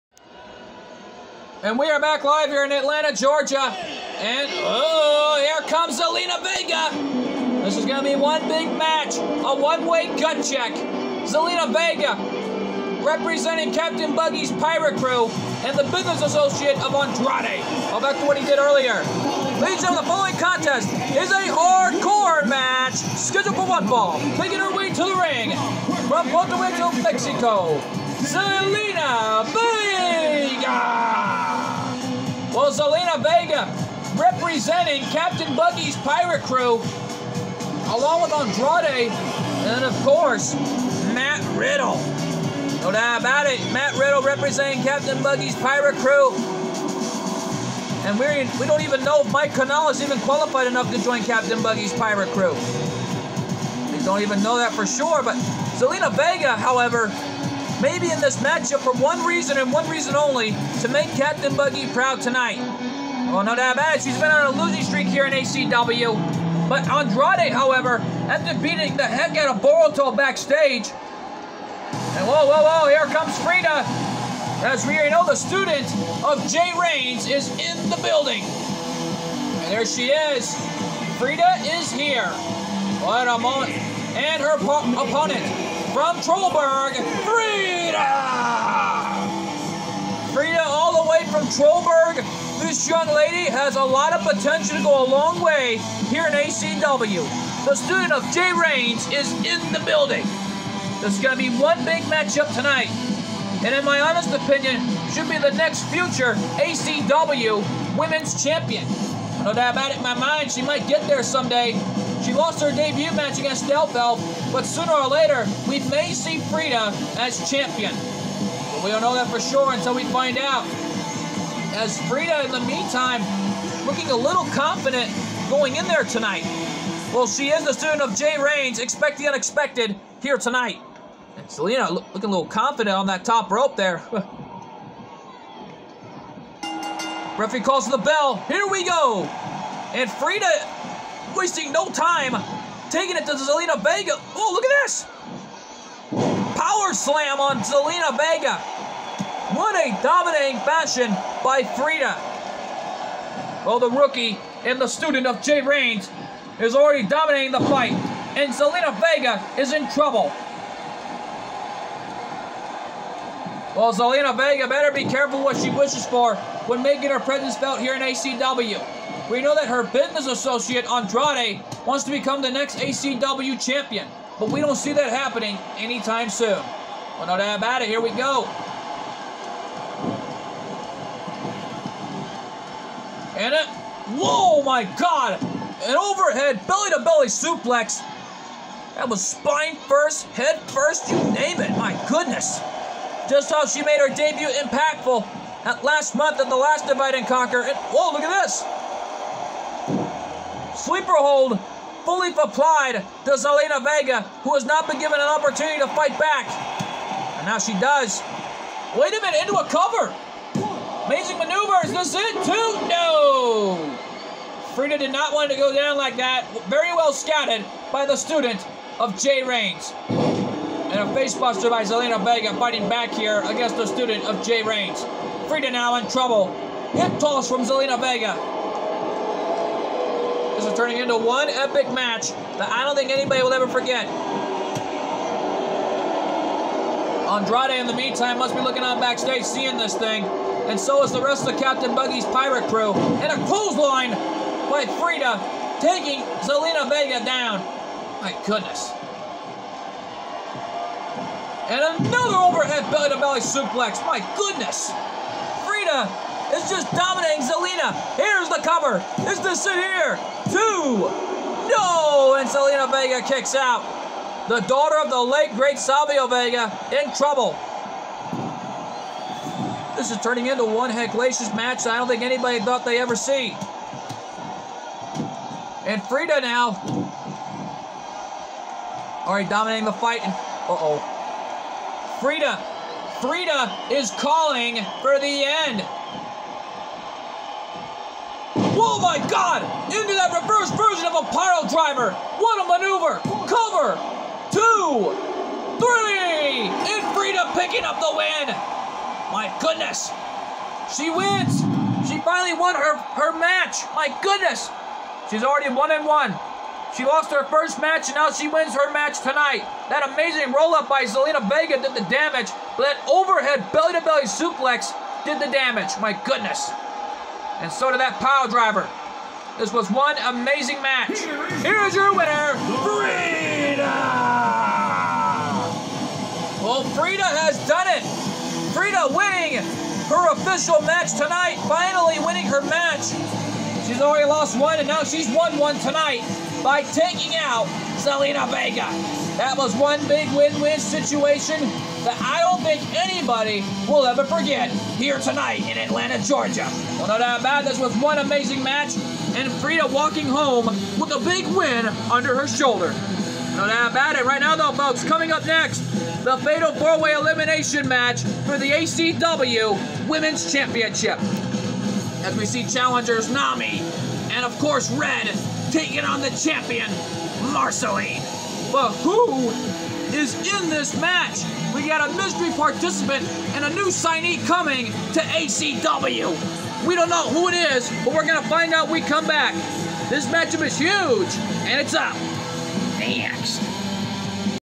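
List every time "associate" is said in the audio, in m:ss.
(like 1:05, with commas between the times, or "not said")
0:16, 2:50.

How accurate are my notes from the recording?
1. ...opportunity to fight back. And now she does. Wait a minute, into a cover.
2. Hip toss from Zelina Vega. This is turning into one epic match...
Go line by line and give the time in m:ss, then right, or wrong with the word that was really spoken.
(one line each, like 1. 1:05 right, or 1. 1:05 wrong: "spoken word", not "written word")
1. 3:25 right
2. 3:46 right.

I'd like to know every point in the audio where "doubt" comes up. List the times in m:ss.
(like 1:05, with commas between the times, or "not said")
0:42, 1:03, 1:49, 2:57, 5:47, 5:53.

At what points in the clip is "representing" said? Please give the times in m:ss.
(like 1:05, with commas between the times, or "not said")
0:13, 0:34, 0:44.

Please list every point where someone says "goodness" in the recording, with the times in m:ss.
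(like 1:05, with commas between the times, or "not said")
3:12, 4:08, 4:14, 4:59, 5:04, 5:16.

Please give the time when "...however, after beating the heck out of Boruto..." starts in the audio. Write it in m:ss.
1:07.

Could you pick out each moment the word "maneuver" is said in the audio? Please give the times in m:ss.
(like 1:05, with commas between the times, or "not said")
3:31, 4:52.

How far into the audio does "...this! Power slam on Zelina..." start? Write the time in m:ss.
2:24.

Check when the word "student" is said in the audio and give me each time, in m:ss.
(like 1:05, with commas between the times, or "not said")
1:15, 1:37, 2:07, 2:34, 3:38, 3:43.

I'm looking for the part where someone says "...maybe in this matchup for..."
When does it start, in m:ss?
0:57.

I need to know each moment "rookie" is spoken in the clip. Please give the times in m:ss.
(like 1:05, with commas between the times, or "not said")
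2:33.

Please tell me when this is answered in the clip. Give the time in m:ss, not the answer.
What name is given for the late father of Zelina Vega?
4:25.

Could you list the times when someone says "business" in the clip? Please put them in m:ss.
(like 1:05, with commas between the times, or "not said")
0:15, 2:49.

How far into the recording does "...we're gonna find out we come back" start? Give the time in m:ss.
6:18.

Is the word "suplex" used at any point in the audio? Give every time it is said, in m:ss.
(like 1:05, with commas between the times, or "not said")
3:07, 4:13, 5:14.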